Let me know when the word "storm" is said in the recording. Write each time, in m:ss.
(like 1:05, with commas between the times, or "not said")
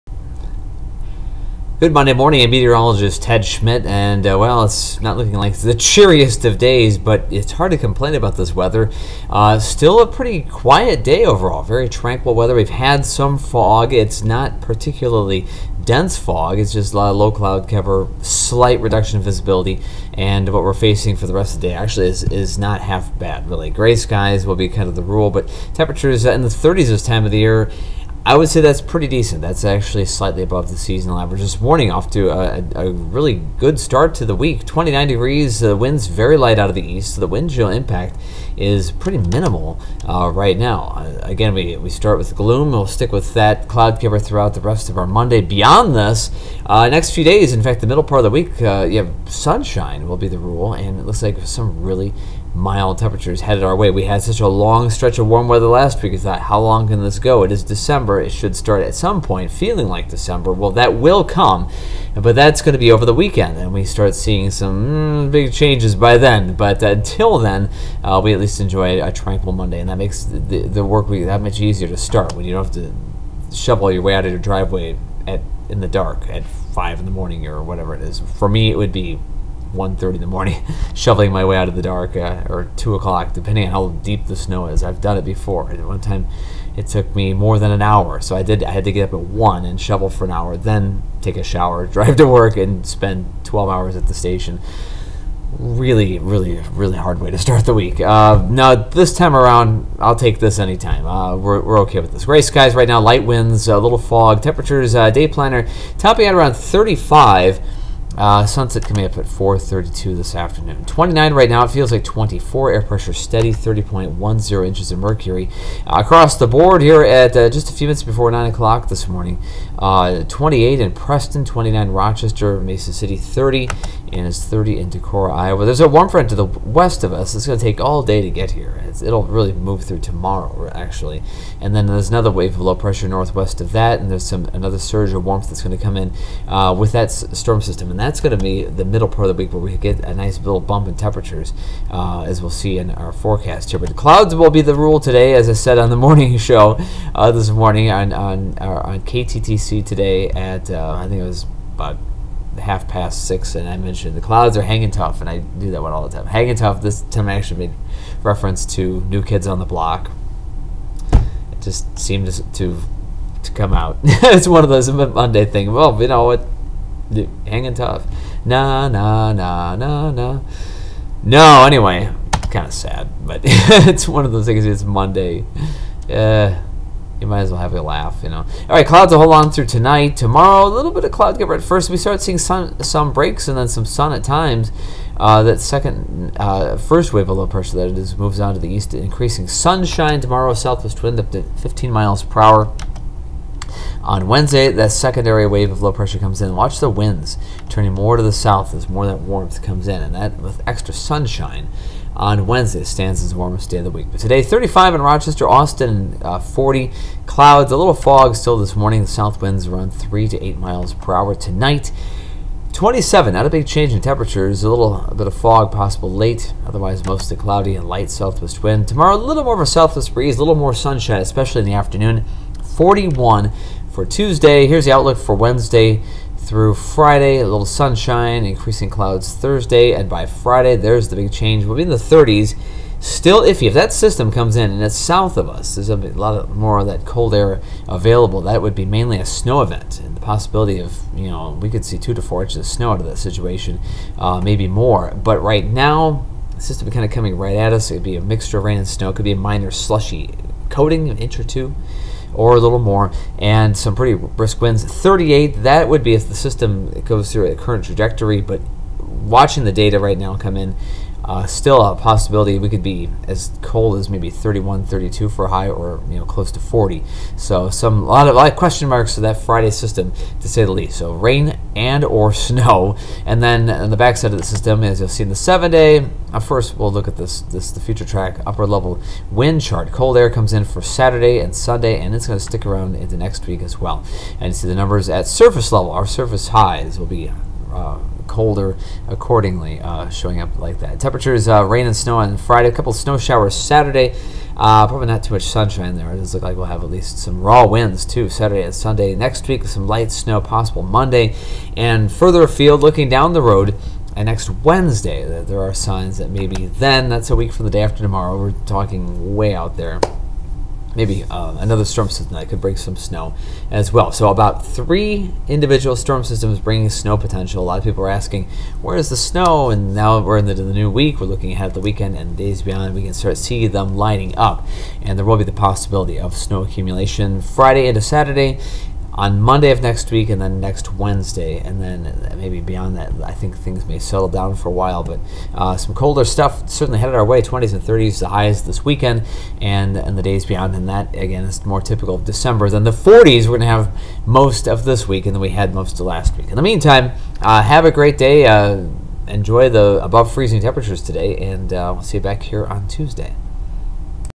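2:17, 5:11, 5:15.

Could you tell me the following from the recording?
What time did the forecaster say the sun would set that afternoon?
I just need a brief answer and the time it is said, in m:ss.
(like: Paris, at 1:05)
4:32, at 1:49.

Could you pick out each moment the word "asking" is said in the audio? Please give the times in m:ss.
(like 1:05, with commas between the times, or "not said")
5:18.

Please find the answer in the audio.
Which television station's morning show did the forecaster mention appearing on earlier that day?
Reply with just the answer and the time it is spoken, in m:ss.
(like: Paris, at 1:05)
KTTC, at 2:29.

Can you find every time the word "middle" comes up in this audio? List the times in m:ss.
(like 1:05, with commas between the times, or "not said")
0:47, 2:18.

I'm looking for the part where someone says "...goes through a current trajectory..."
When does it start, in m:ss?
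4:17.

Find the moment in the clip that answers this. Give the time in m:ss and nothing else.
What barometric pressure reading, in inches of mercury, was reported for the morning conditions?
1:53.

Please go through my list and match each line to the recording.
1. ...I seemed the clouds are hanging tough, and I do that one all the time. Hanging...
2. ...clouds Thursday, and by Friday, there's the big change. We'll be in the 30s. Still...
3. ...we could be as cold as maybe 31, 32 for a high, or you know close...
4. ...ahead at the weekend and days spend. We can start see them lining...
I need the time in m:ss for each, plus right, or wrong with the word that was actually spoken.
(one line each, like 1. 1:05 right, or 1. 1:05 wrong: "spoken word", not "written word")
1. 2:33 wrong: "mentioned", not "seemed"
2. 3:48 right
3. 4:22 right
4. 5:21 wrong: "beyond", not "spend".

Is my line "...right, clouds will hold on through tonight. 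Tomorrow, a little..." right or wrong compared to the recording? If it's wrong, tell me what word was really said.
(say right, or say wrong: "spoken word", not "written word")
right.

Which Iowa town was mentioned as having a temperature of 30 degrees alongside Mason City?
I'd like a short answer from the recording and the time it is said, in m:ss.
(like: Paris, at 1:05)
Decorah, at 2:04.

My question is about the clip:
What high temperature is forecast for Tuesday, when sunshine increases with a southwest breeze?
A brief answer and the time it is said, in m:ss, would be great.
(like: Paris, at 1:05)
41, at 3:42.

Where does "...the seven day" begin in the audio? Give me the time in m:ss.
4:35.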